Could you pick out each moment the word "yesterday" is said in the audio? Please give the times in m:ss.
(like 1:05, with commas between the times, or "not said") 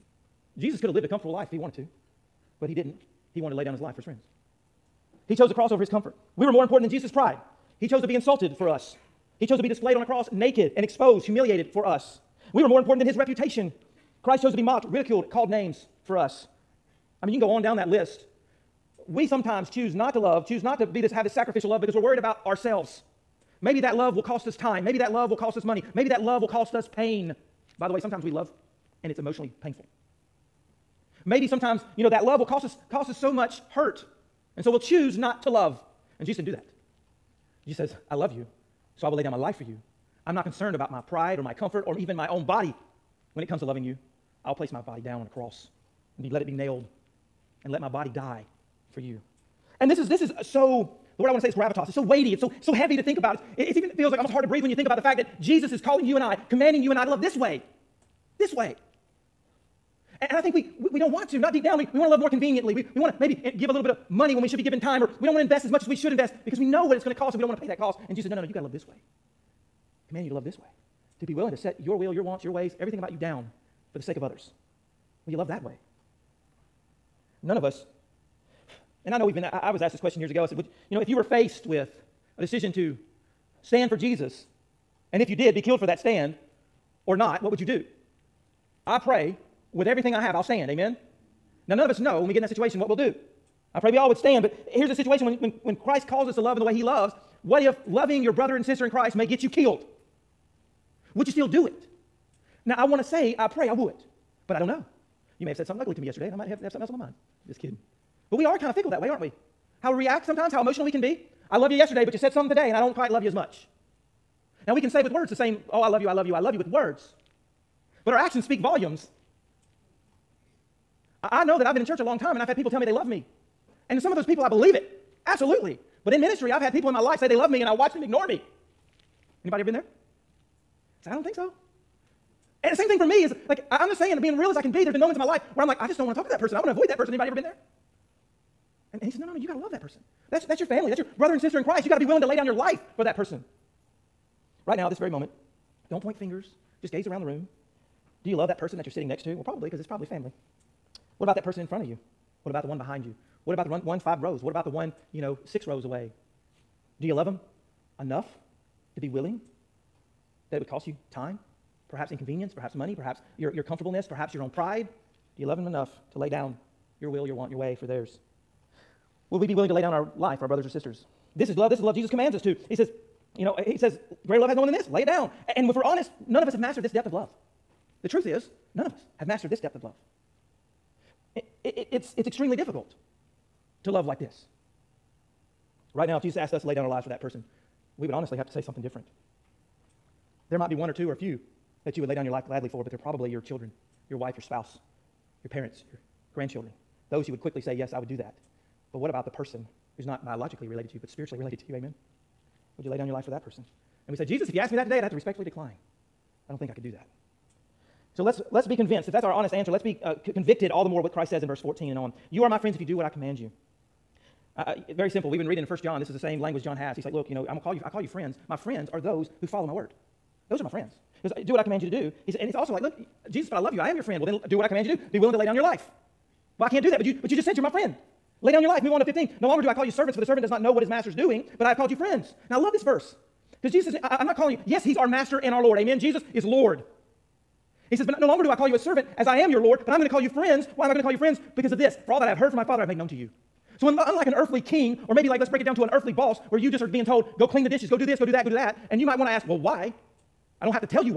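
1:46, 1:51.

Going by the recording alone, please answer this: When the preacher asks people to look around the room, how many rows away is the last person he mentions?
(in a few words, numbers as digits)
6.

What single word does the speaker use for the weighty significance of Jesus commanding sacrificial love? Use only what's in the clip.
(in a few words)
Gravitas.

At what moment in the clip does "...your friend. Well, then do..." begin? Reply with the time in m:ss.
3:43.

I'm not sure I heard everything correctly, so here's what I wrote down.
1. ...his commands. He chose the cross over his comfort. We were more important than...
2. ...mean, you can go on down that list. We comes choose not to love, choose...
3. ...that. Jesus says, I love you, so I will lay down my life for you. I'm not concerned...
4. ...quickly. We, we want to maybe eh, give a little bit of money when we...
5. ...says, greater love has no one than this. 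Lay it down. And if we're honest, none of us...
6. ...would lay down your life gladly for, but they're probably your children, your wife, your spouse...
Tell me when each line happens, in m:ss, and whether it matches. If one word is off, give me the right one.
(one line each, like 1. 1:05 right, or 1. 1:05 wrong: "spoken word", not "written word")
1. 0:03 wrong: "friends", not "commands"
2. 0:17 wrong: "sometimes", not "comes"
3. 0:36 right
4. 1:02 wrong: "conveniently", not "quickly"
5. 2:53 right
6. 3:12 right.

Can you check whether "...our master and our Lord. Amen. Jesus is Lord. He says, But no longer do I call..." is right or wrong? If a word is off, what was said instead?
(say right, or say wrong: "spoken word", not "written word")
right.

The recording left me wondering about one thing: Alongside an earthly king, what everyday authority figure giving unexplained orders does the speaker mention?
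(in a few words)
Earthly boss.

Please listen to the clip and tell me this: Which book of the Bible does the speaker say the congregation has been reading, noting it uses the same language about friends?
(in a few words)
First John.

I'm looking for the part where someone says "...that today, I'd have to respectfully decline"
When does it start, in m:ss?
3:24.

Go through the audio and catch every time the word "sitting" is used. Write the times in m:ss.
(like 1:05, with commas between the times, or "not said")
2:28.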